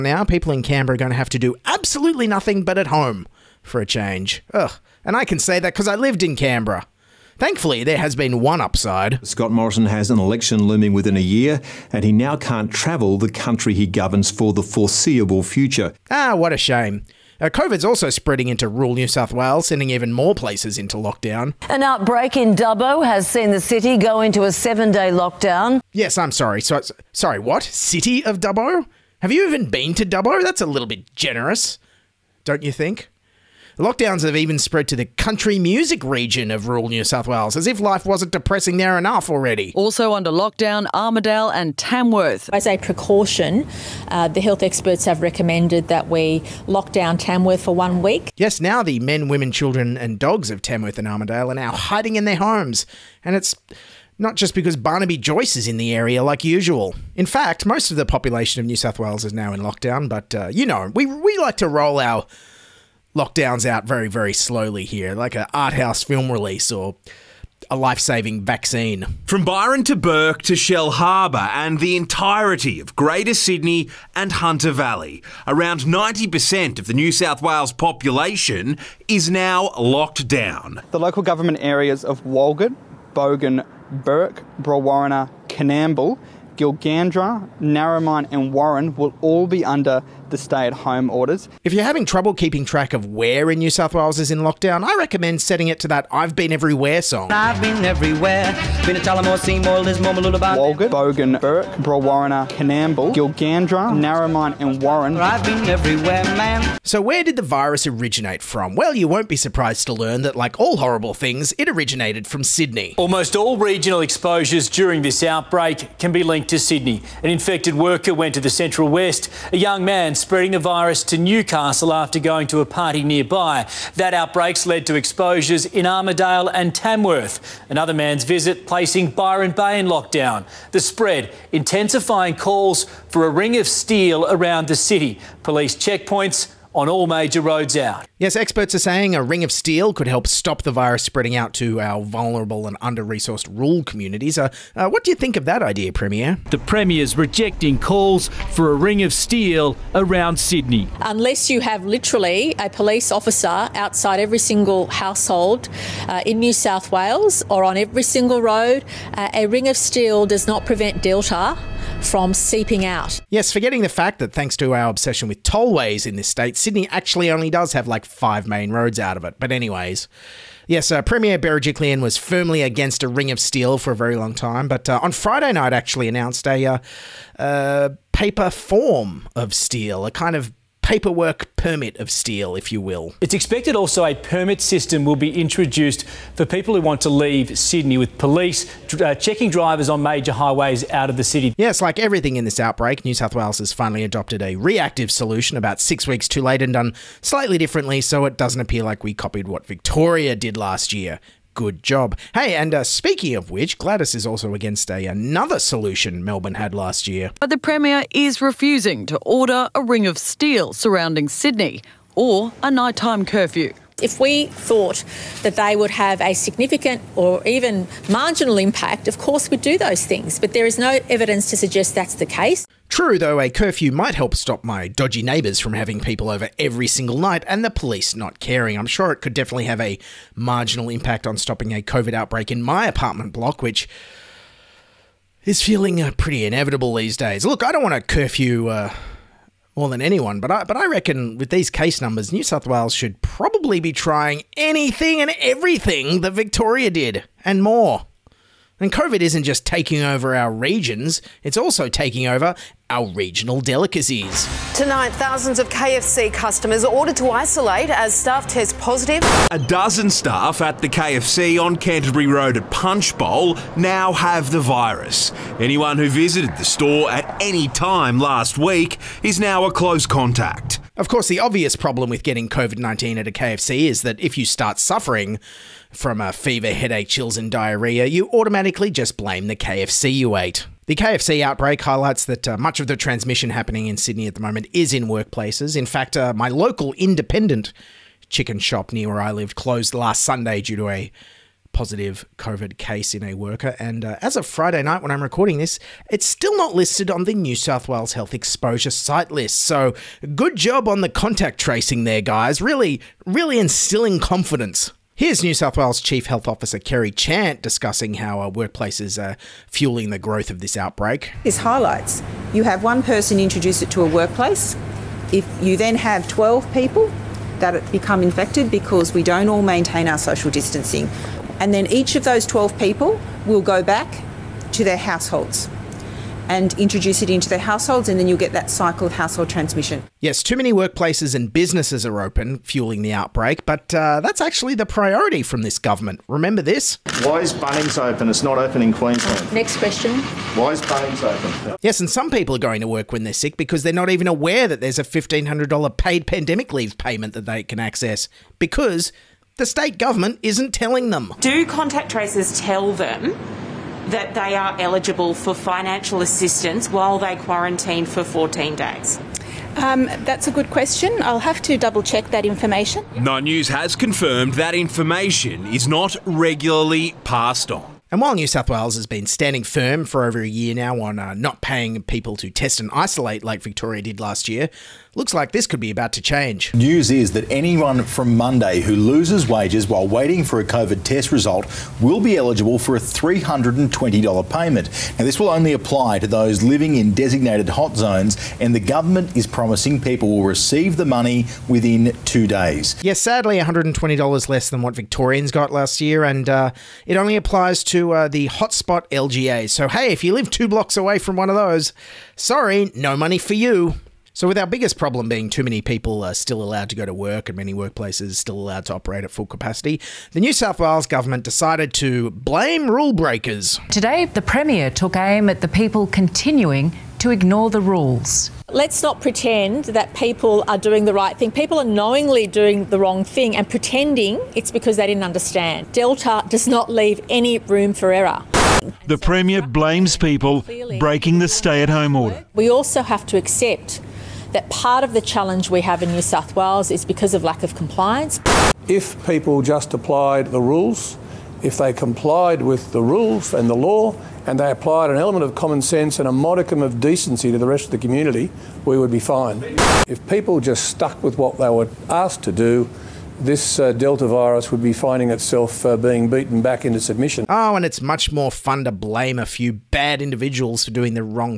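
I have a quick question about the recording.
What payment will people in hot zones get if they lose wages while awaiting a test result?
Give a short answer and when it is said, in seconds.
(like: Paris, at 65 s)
$320, at 382 s.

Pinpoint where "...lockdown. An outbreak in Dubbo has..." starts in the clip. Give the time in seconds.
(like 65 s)
20 s.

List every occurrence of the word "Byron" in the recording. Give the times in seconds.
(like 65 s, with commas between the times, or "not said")
69 s, 129 s.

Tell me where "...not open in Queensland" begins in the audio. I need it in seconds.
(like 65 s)
338 s.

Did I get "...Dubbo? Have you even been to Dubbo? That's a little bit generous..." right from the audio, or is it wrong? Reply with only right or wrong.
right.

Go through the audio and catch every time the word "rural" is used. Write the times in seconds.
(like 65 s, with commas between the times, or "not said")
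18 s, 36 s, 143 s.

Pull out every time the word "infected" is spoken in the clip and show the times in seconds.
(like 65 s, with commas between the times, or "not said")
117 s, 318 s.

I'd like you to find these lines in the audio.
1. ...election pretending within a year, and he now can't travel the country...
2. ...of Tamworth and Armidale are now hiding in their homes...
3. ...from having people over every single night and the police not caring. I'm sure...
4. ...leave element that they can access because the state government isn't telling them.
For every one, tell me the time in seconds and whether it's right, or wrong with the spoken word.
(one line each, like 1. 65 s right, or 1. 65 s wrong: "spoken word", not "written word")
1. 10 s wrong: "looming", not "pretending"
2. 50 s right
3. 225 s right
4. 346 s wrong: "payment", not "element".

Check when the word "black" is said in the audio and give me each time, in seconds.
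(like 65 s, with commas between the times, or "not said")
not said.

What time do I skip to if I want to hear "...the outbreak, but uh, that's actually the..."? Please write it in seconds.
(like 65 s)
333 s.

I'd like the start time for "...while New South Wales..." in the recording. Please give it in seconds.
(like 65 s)
368 s.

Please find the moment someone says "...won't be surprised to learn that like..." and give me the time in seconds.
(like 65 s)
109 s.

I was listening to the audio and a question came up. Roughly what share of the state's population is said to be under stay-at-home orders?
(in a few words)
90%.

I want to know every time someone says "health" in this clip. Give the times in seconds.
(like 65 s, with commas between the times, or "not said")
44 s, 298 s, 306 s.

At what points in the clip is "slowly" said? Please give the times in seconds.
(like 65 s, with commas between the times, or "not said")
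64 s.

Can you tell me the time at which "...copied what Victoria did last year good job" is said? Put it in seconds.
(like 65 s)
199 s.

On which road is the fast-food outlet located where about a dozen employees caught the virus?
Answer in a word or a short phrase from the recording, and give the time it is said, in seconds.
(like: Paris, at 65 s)
Canterbury Road, at 261 s.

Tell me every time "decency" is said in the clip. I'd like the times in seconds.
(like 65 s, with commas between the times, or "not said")
446 s.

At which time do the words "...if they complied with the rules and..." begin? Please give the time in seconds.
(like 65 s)
441 s.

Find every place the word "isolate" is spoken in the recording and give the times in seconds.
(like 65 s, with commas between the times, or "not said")
257 s, 372 s.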